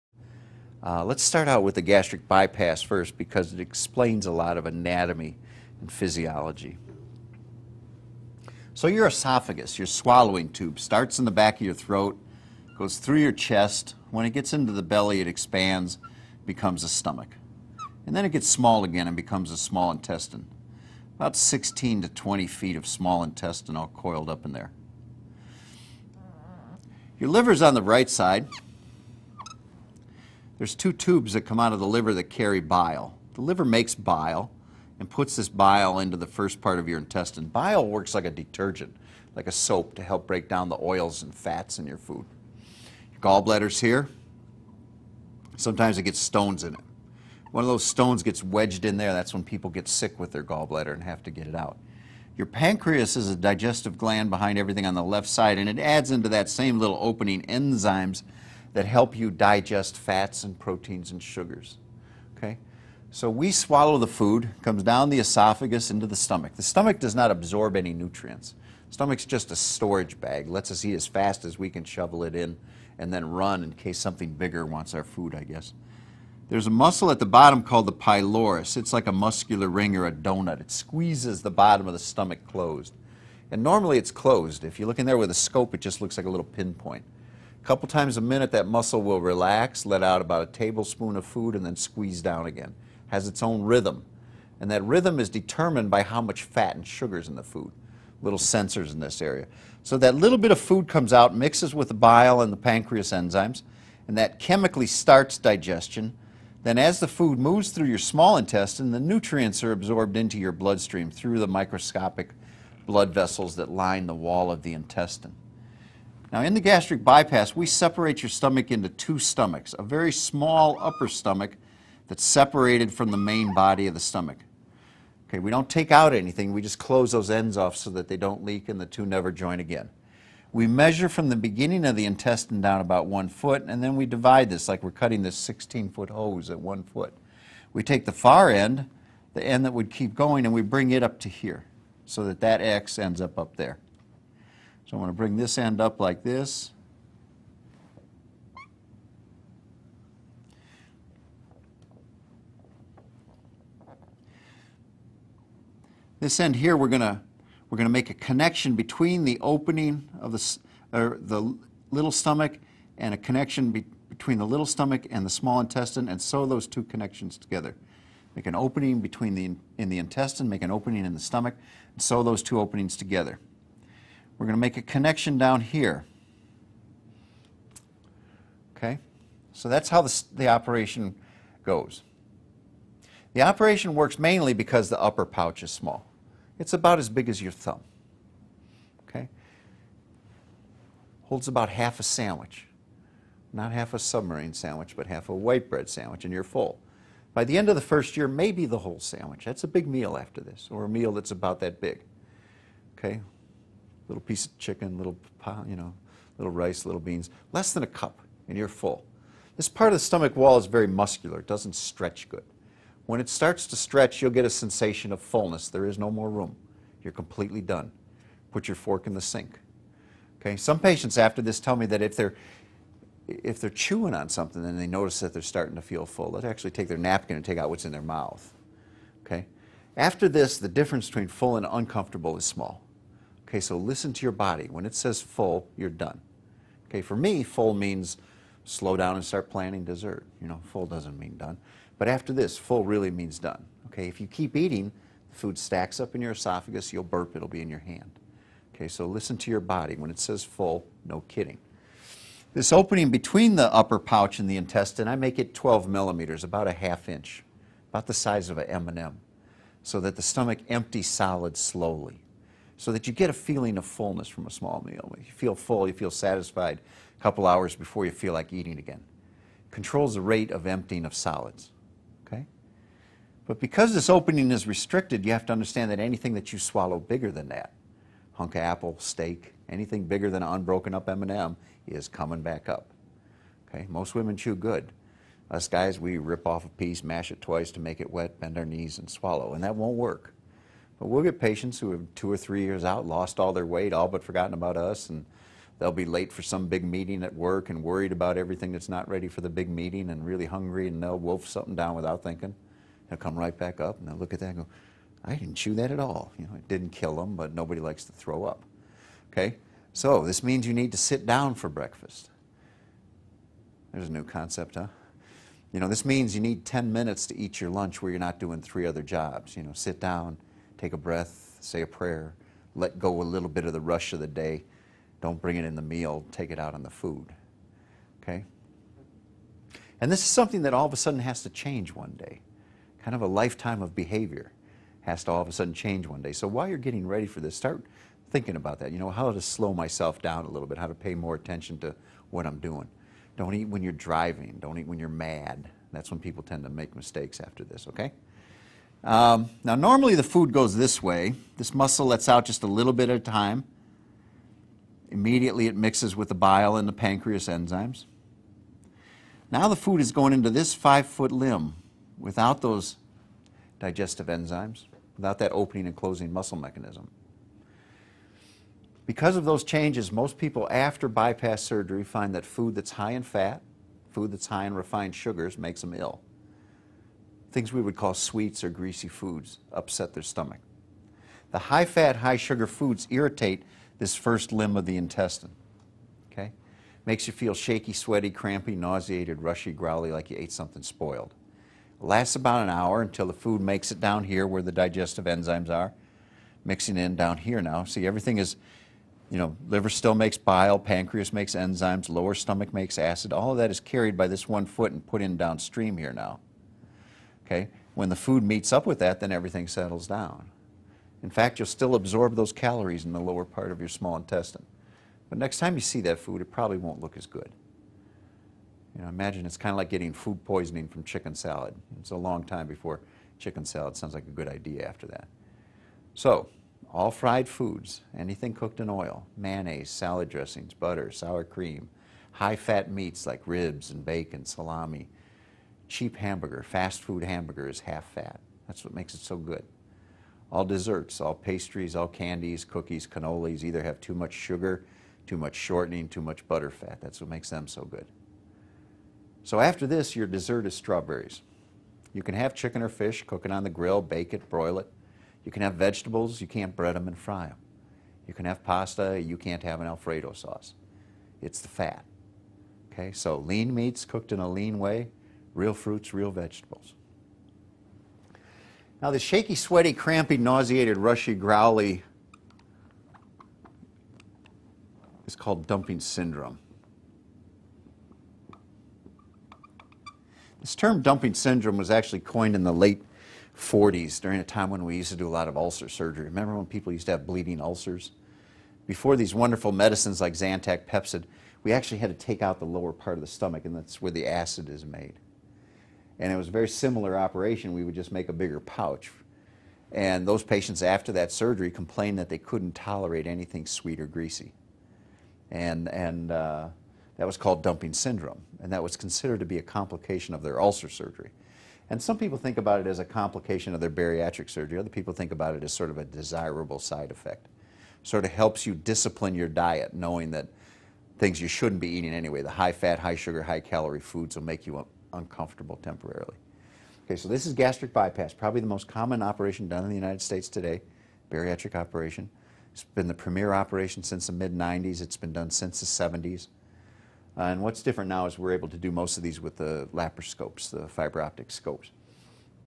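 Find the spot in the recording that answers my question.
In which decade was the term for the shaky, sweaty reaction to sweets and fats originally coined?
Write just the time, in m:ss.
8:02.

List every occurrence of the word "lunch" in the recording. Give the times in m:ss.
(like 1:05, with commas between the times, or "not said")
5:17.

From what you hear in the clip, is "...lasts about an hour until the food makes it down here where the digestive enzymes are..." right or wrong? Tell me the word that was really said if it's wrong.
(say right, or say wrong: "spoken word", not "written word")
right.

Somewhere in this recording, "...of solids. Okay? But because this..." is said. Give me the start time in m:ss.
4:31.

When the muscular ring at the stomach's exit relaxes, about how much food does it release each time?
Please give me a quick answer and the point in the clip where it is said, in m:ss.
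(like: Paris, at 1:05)
a tablespoon, at 1:30.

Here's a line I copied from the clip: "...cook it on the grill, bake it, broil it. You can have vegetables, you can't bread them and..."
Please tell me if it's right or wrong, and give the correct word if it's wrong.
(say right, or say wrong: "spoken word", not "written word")
right.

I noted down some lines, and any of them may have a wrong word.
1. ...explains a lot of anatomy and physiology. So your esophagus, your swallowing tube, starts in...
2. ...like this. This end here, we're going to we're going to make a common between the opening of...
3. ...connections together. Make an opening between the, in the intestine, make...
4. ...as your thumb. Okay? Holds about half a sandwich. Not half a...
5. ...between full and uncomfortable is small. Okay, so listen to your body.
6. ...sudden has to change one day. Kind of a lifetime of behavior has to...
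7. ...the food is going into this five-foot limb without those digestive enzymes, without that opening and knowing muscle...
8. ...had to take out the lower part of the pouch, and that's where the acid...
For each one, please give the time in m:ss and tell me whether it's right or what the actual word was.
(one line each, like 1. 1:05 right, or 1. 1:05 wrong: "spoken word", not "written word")
1. 0:03 right
2. 2:26 wrong: "connection", not "common"
3. 2:46 right
4. 3:07 right
5. 3:51 right
6. 5:30 right
7. 5:59 wrong: "closing", not "knowing"
8. 8:11 wrong: "stomach", not "pouch".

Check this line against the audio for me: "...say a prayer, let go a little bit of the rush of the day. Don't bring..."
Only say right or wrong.
right.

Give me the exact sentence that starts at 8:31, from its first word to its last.
And some people think about it as a complication of their bariatric surgery.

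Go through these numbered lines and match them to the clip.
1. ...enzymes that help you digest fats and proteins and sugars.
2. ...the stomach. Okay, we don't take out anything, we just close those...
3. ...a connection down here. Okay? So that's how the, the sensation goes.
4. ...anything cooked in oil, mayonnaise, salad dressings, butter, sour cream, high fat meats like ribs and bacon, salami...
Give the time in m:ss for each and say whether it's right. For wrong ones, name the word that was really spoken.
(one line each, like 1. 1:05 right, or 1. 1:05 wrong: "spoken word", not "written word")
1. 0:57 right
2. 2:03 right
3. 2:54 wrong: "operation", not "sensation"
4. 7:08 right.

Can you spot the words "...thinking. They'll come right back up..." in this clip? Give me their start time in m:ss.
5:02.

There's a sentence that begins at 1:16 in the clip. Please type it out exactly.
There's a muscle at the bottom called the pylorus.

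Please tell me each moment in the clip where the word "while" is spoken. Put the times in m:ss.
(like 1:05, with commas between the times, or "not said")
5:36.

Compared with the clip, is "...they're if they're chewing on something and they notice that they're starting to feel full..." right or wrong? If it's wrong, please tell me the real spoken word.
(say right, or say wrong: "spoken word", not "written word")
right.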